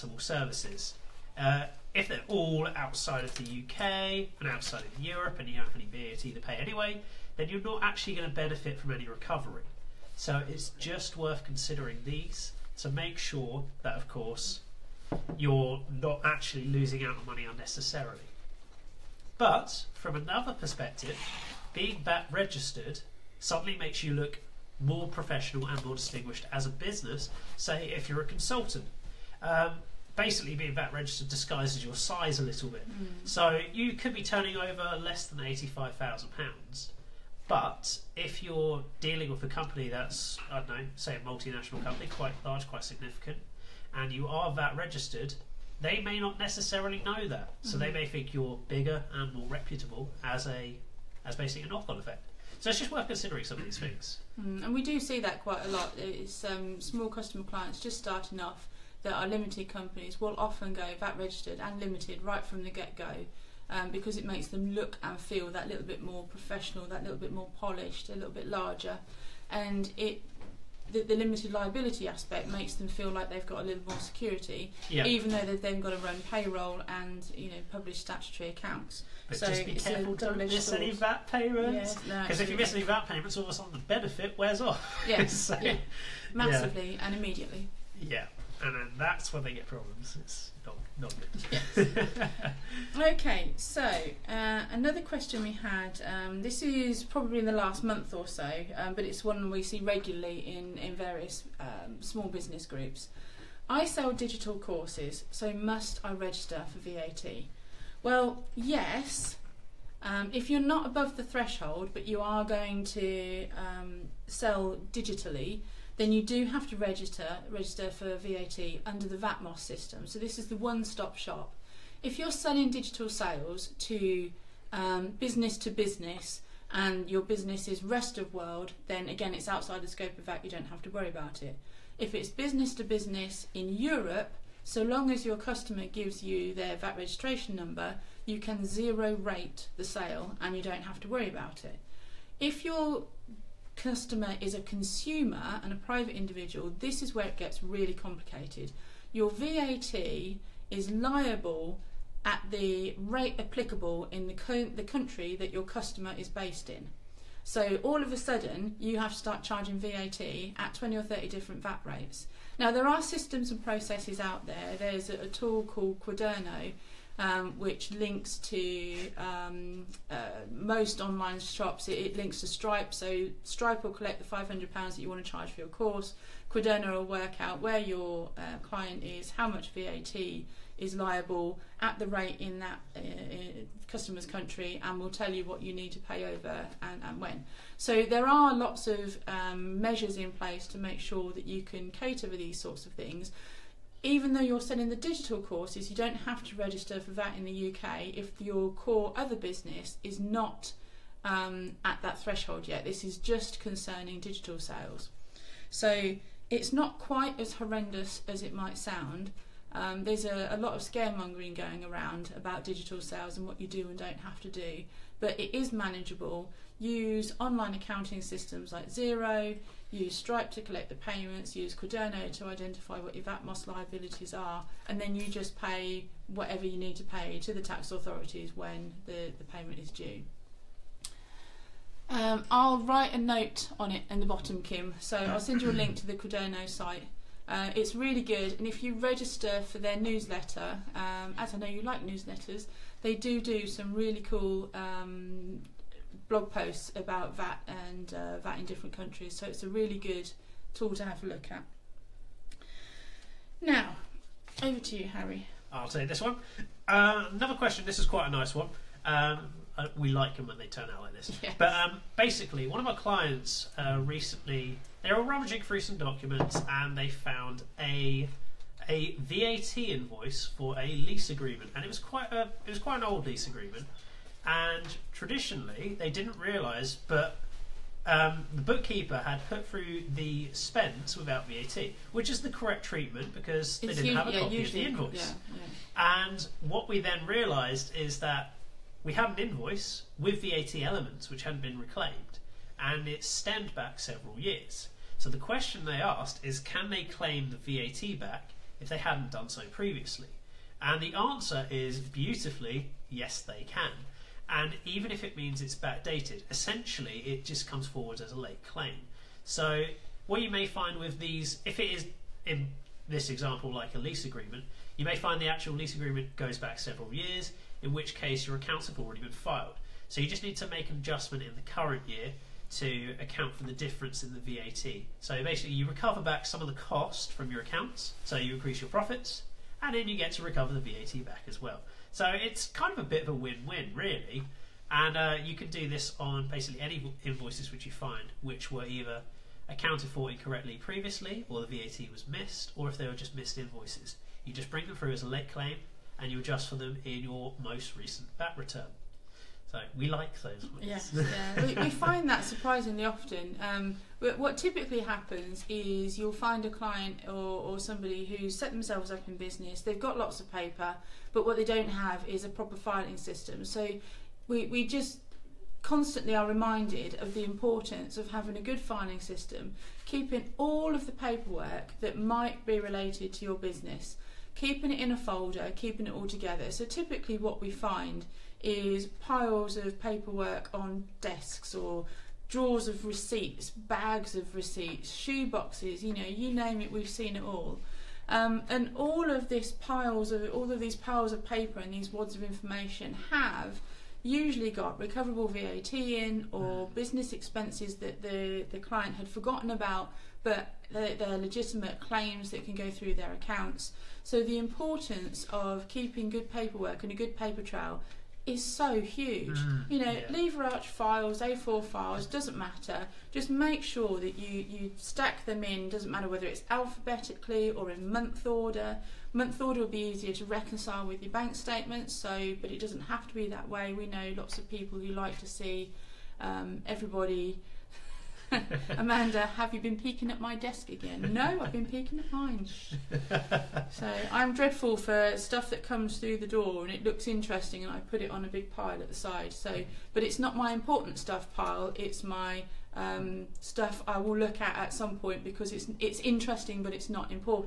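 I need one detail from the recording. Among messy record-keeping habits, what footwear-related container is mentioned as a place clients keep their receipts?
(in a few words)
Shoe boxes.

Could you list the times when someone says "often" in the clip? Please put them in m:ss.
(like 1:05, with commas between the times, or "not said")
1:00, 5:53.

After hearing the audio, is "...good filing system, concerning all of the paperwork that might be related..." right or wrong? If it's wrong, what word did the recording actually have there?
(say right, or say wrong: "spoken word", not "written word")
wrong: "keeping", not "concerning".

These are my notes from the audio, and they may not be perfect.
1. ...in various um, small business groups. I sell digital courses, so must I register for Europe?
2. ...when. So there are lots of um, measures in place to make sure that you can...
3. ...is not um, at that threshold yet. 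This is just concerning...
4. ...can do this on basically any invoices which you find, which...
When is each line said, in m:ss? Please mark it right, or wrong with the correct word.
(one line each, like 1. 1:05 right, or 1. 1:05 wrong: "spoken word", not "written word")
1. 1:40 wrong: "VAT", not "Europe"
2. 3:07 right
3. 3:20 right
4. 5:35 right.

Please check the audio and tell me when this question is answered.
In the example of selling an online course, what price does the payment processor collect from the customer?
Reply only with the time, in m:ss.
2:54.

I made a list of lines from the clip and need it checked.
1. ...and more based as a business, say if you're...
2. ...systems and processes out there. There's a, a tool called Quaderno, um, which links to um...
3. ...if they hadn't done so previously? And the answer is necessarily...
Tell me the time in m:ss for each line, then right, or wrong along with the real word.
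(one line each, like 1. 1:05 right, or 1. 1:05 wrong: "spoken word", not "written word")
1. 0:25 wrong: "distinguished", not "based"
2. 2:43 right
3. 4:58 wrong: "beautifully", not "necessarily".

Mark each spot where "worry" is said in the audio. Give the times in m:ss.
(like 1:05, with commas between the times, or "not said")
2:10, 2:21.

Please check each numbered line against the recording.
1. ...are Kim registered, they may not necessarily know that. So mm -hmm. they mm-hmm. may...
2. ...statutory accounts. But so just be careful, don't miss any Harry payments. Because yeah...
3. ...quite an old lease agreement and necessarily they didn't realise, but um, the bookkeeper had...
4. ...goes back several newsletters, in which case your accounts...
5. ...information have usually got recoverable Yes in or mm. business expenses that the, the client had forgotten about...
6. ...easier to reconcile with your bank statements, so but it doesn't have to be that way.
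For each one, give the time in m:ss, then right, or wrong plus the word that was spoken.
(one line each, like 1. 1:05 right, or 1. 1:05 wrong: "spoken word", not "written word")
1. 0:44 wrong: "VAT", not "Kim"
2. 1:17 wrong: "VAT", not "Harry"
3. 4:32 wrong: "traditionally", not "necessarily"
4. 5:16 wrong: "years", not "newsletters"
5. 6:32 wrong: "VAT", not "Yes"
6. 6:59 right.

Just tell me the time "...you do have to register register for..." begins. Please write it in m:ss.
1:56.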